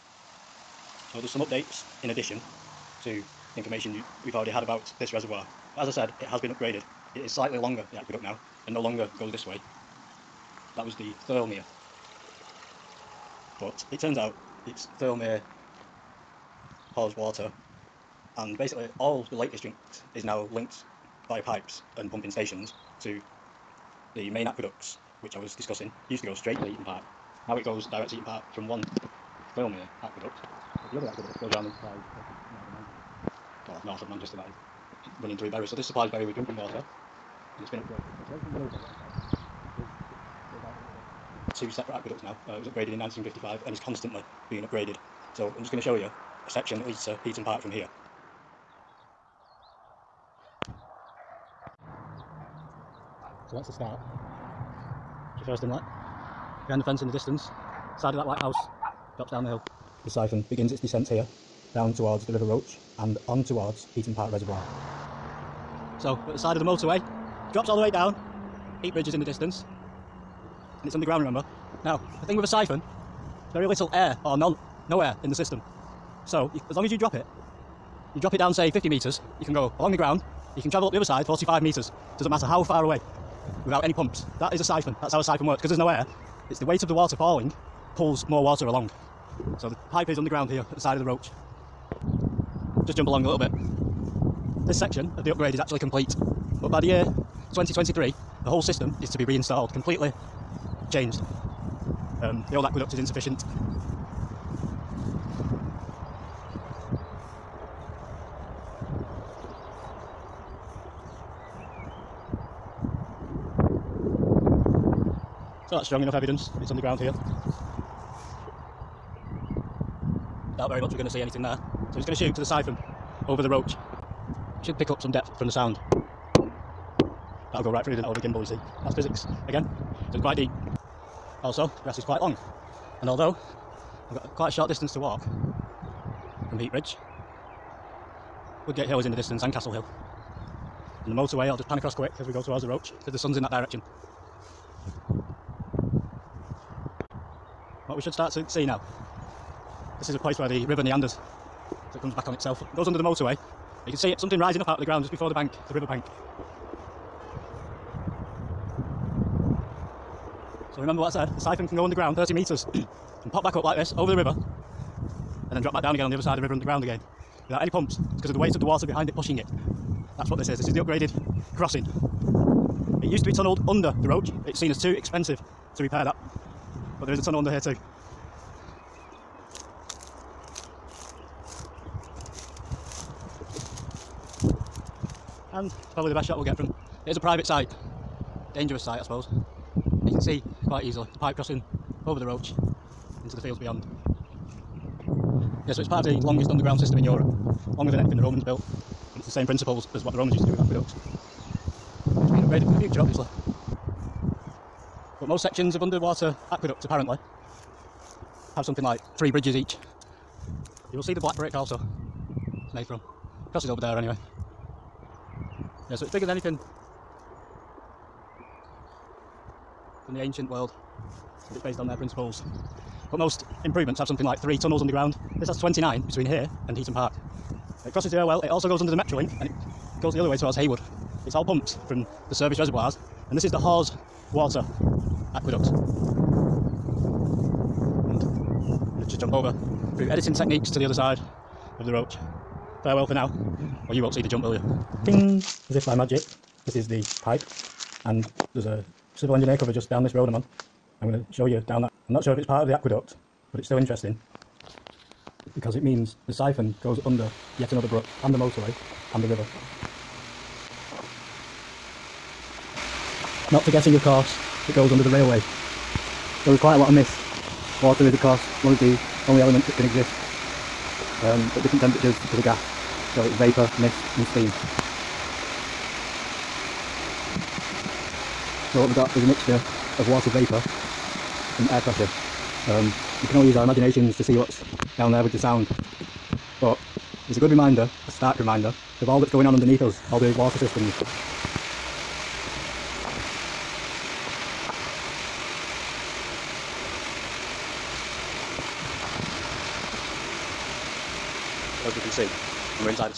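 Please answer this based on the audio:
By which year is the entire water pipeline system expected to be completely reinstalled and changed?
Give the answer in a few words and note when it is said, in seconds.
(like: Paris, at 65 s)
2023, at 97 s.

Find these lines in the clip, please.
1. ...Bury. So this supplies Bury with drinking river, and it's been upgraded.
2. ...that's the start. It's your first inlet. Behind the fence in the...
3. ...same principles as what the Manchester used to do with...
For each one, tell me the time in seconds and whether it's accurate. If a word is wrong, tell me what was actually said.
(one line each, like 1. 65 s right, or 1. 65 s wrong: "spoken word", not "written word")
1. 35 s wrong: "water", not "river"
2. 53 s right
3. 199 s wrong: "Romans", not "Manchester".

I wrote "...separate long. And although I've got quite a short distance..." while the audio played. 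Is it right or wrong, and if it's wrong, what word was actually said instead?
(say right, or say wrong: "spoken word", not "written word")
wrong: "quite", not "separate".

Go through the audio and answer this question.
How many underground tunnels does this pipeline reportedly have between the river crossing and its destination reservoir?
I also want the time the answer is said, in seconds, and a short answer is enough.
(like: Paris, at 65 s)
29, at 225 s.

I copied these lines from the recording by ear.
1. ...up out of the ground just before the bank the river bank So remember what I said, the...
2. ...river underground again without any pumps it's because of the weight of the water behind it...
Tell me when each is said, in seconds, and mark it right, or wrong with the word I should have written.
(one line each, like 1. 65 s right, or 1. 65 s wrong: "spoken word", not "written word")
1. 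154 s right
2. 166 s right.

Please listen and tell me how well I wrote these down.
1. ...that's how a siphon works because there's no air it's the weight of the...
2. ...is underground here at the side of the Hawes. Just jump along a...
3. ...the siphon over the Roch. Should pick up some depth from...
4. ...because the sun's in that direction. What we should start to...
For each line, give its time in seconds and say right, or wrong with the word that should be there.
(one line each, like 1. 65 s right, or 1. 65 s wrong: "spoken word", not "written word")
1. 85 s right
2. 90 s wrong: "Roch", not "Hawes"
3. 122 s right
4. 142 s right.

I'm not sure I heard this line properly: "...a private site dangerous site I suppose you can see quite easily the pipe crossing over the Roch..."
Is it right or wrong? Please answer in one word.
right.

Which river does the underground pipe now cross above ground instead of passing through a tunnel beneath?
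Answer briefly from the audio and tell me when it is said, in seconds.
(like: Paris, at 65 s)
River Roch, at 62 s.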